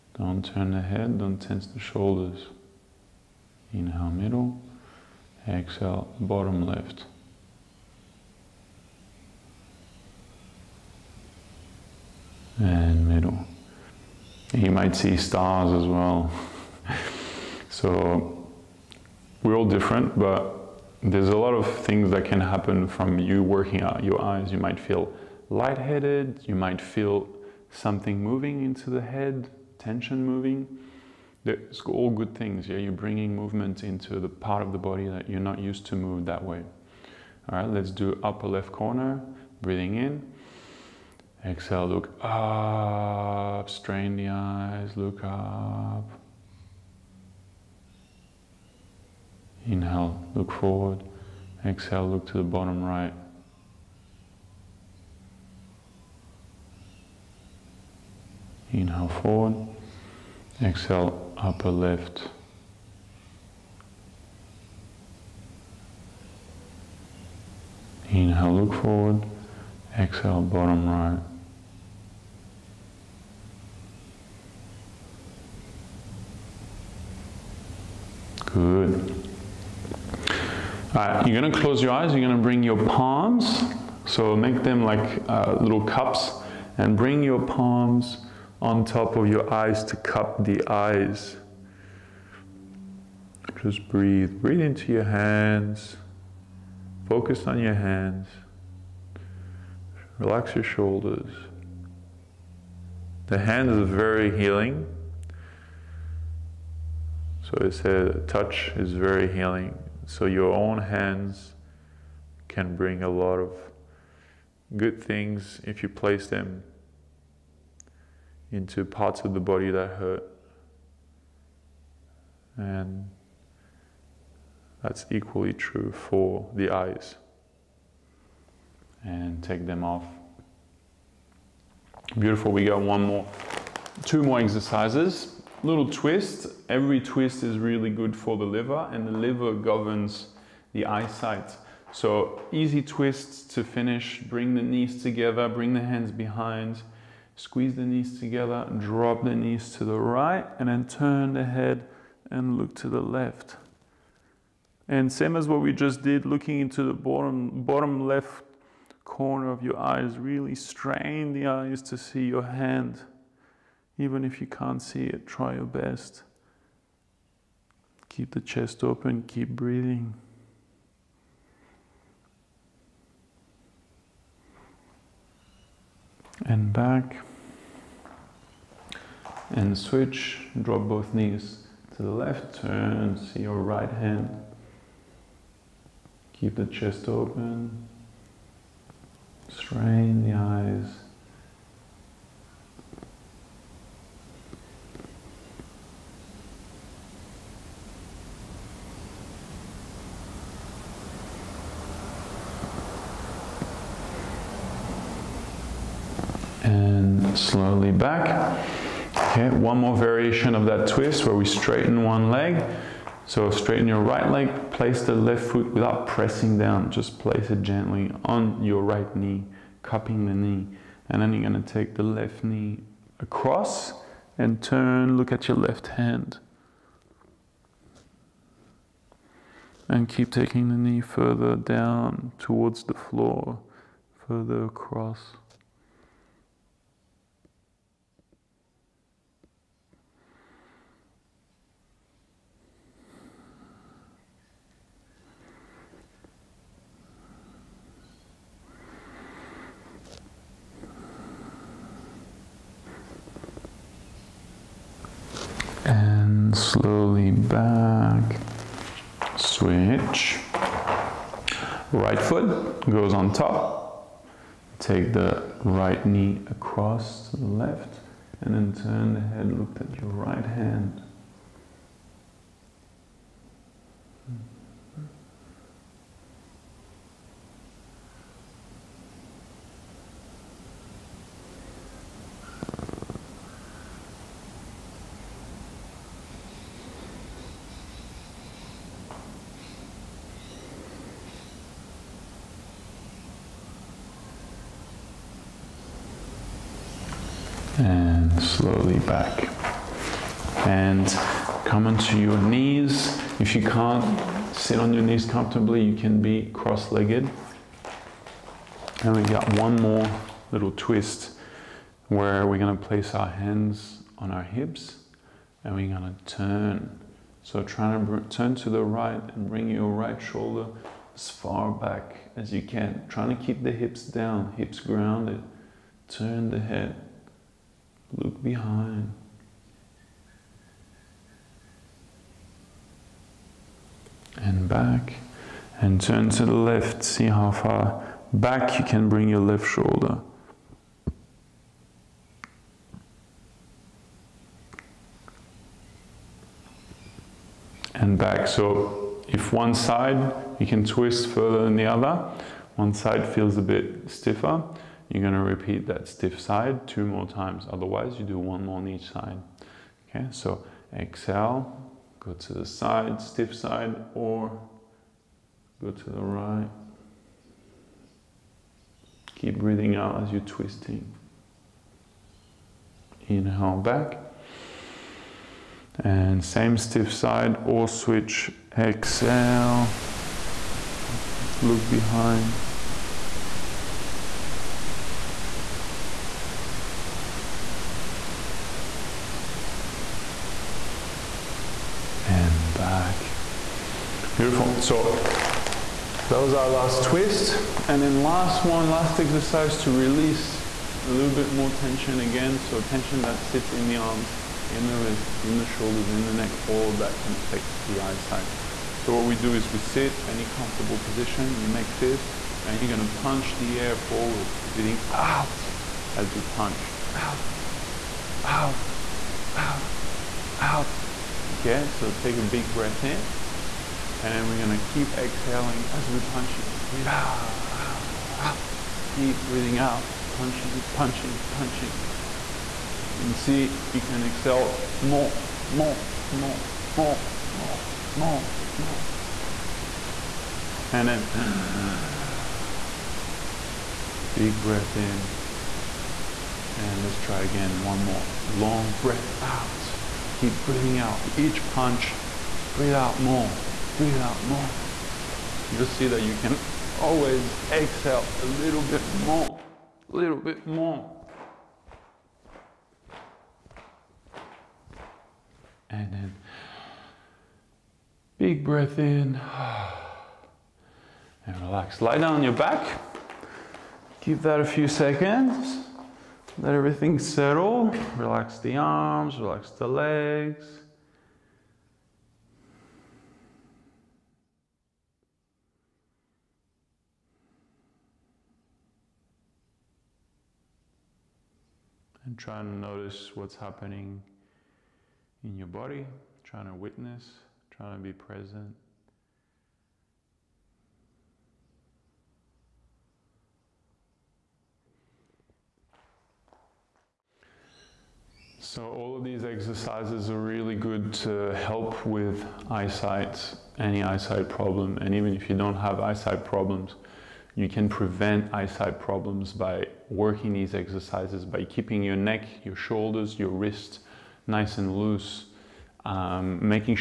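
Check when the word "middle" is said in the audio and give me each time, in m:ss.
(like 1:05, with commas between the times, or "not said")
0:04, 0:13.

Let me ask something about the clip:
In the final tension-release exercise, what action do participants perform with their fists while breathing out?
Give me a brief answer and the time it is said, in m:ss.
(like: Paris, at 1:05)
Punch the air, at 6:53.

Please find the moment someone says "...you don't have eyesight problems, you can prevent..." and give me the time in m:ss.
8:35.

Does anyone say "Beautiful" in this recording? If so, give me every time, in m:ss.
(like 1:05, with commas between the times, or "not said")
2:12, 6:34.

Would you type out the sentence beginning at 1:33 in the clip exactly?
Just breathe, breathe into your hands, focus on your hands, relax your shoulders.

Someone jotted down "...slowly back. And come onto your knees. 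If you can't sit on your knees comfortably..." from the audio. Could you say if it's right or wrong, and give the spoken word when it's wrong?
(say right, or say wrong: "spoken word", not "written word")
right.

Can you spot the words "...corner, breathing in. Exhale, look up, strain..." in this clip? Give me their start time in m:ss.
0:38.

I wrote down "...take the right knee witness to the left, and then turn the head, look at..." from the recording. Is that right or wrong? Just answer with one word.
wrong.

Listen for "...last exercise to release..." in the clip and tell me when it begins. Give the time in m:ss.
6:38.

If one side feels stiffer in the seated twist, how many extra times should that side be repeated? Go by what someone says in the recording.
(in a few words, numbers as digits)
Two more times.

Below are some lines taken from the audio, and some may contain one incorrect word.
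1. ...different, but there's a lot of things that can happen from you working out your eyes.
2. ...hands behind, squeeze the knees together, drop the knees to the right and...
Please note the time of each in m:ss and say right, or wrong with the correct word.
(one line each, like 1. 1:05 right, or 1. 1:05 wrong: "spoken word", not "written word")
1. 0:19 right
2. 2:25 right.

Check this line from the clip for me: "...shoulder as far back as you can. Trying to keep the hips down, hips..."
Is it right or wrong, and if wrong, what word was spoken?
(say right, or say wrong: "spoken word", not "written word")
right.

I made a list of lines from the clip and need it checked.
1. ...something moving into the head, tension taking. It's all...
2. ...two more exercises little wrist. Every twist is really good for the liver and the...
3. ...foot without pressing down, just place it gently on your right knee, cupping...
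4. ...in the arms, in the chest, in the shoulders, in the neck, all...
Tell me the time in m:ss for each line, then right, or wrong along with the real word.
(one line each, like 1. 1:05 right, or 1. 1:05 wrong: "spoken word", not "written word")
1. 0:27 wrong: "moving", not "taking"
2. 2:14 wrong: "twist", not "wrist"
3. 3:35 right
4. 6:43 wrong: "wrist", not "chest".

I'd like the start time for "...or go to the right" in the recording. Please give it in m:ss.
6:04.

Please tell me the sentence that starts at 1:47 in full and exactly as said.
So it said touch is very healing.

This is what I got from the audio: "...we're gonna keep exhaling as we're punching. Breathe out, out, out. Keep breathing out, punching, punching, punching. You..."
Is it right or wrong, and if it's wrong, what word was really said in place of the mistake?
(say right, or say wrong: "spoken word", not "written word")
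right.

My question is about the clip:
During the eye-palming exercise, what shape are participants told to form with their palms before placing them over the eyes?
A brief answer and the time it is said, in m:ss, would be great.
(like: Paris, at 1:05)
Little cups, at 1:25.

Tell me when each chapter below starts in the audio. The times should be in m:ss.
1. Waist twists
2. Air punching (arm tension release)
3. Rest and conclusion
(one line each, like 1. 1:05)
1. 2:20
2. 6:40
3. 8:10.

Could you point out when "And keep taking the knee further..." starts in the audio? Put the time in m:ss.
3:49.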